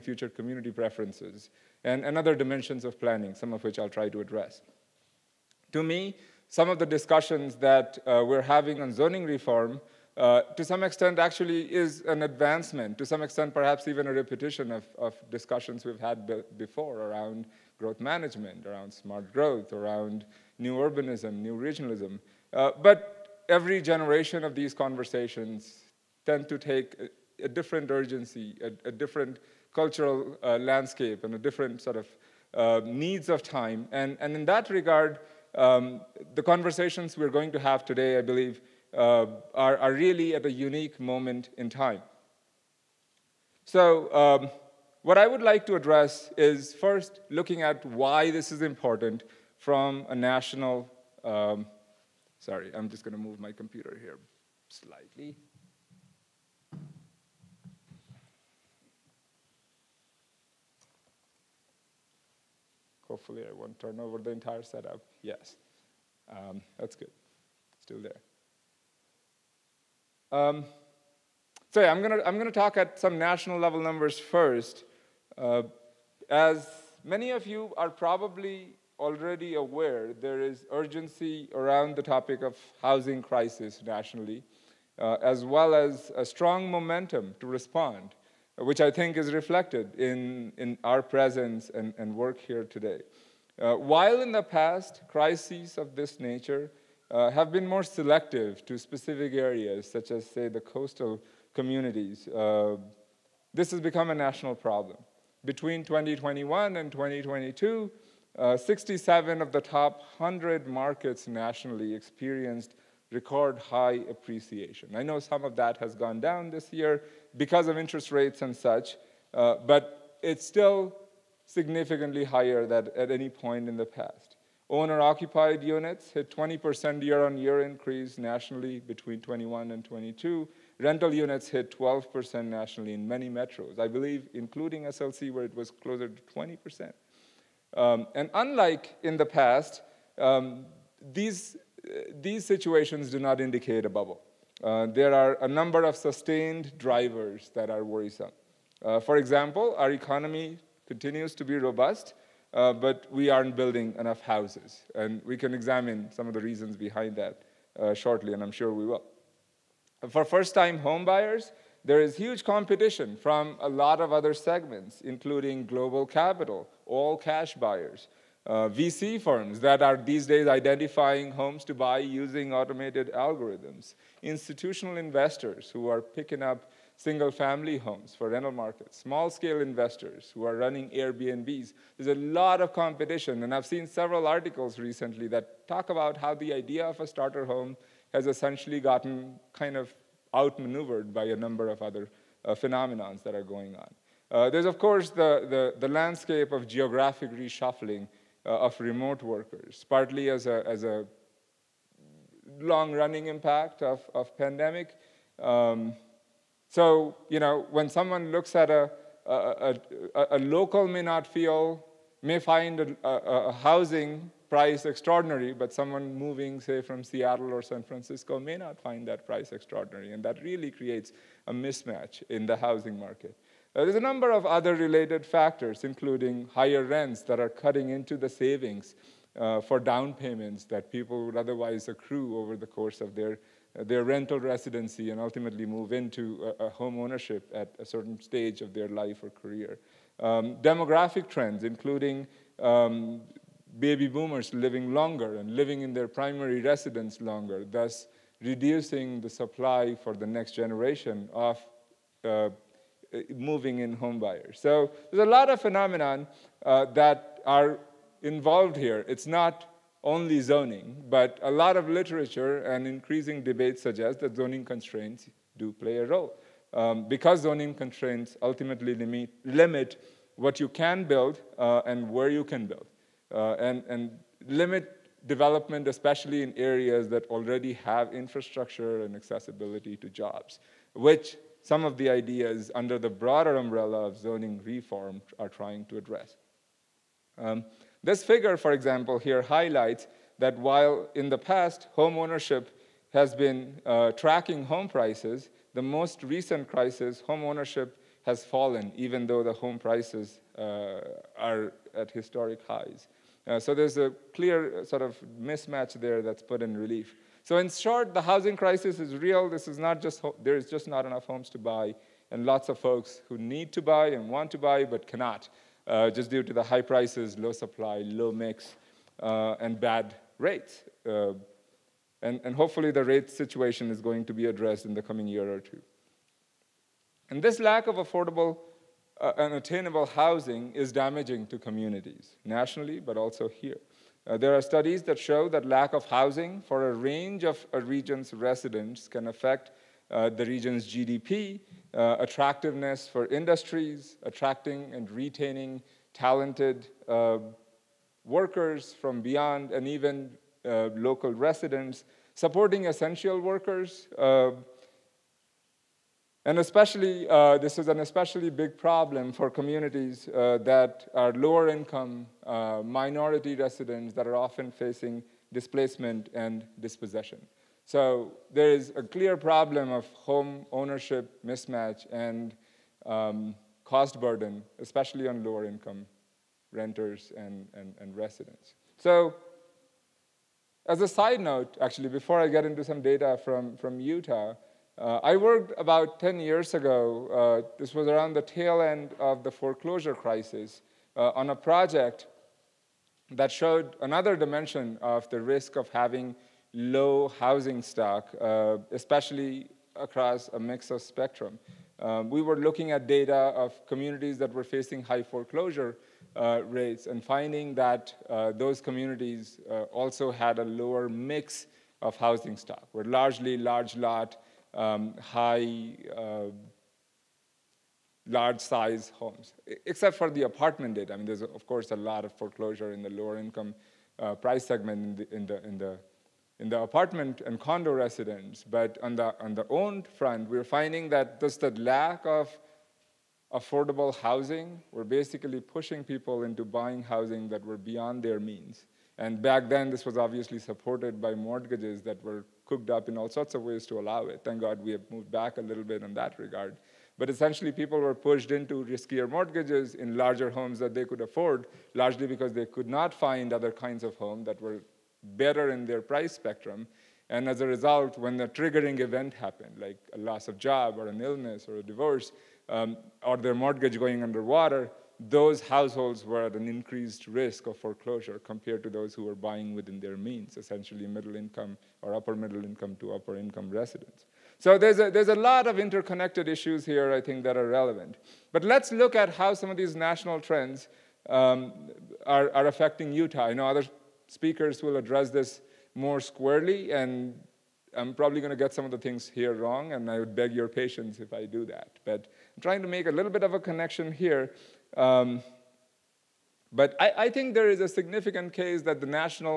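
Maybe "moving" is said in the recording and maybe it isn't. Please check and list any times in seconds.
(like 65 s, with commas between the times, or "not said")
216 s, 253 s.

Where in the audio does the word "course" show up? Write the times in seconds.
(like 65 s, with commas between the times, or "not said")
194 s, 232 s, 421 s.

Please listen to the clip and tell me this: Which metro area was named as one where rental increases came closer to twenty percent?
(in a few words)
SLC.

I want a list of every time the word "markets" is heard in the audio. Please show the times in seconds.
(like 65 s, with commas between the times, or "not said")
110 s, 178 s, 222 s.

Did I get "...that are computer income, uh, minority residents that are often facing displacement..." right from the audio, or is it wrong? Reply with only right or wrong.
wrong.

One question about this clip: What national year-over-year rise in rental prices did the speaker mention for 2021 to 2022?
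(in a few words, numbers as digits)
12%.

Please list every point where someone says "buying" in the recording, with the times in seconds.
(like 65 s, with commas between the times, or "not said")
436 s, 469 s.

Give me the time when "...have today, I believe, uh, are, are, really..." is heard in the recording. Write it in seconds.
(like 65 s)
37 s.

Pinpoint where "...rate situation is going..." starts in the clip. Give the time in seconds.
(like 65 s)
323 s.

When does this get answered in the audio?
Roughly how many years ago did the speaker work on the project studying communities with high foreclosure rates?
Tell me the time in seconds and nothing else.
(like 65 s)
386 s.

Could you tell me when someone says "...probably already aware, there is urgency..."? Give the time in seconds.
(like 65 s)
77 s.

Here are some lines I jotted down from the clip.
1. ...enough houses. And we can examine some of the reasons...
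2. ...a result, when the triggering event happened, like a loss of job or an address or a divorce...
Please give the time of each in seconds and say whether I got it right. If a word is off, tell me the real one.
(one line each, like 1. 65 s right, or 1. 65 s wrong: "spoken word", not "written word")
1. 153 s right
2. 457 s wrong: "illness", not "address".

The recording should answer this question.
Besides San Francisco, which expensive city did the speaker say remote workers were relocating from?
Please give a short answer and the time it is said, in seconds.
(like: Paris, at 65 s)
Seattle, at 217 s.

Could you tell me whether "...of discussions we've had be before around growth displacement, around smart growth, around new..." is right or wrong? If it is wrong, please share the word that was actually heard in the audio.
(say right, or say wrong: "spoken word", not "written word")
wrong: "management", not "displacement".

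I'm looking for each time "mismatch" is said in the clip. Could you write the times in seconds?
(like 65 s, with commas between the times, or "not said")
221 s, 305 s, 371 s.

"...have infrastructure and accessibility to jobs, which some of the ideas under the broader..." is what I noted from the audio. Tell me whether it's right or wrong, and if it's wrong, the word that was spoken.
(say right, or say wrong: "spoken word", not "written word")
right.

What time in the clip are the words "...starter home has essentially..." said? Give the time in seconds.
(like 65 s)
187 s.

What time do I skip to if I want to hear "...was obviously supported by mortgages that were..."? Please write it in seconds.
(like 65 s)
440 s.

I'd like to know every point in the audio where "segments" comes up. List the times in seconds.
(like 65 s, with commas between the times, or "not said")
164 s, 424 s.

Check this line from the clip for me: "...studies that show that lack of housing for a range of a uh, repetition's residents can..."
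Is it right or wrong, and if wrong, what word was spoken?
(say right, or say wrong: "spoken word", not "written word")
wrong: "region", not "repetition".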